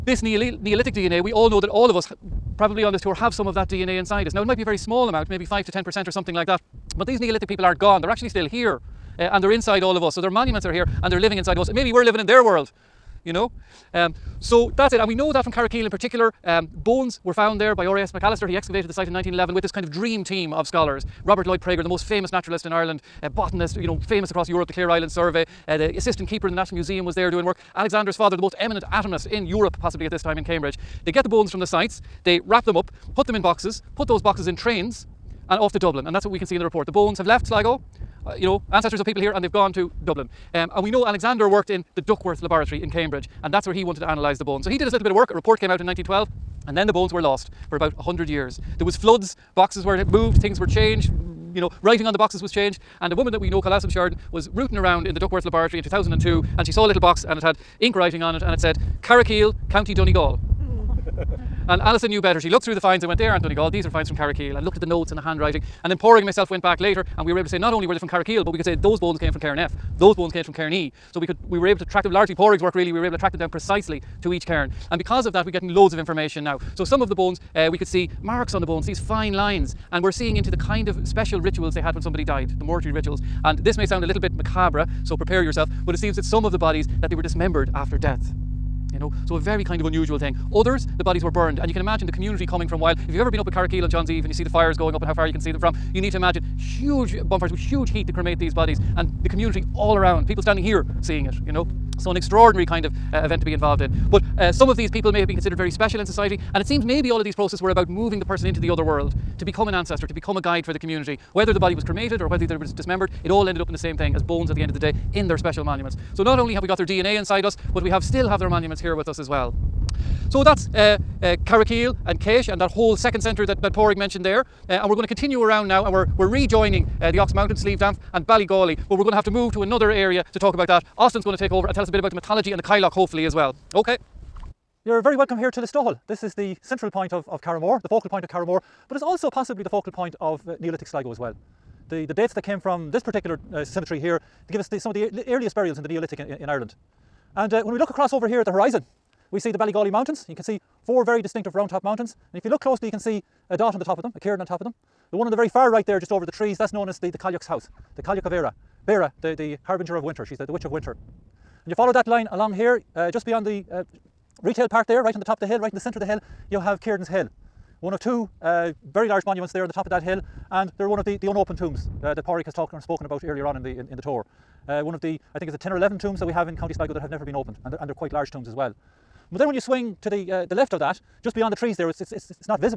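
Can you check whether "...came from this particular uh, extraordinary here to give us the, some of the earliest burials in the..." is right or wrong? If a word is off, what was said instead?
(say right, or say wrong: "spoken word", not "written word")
wrong: "cemetery", not "extraordinary".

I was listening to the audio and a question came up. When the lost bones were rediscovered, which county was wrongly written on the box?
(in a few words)
County Donegal.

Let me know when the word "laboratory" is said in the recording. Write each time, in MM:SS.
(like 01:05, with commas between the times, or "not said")
00:42, 00:55.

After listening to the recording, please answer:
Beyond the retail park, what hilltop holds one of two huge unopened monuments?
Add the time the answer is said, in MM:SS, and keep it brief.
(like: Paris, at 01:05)
Cairns Hill, at 02:46.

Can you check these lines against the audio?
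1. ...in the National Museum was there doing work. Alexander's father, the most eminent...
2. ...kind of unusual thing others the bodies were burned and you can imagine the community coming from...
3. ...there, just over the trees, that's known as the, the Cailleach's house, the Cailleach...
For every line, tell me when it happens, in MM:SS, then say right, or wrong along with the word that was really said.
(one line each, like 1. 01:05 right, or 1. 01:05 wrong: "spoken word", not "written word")
1. 00:26 right
2. 01:29 right
3. 02:35 right.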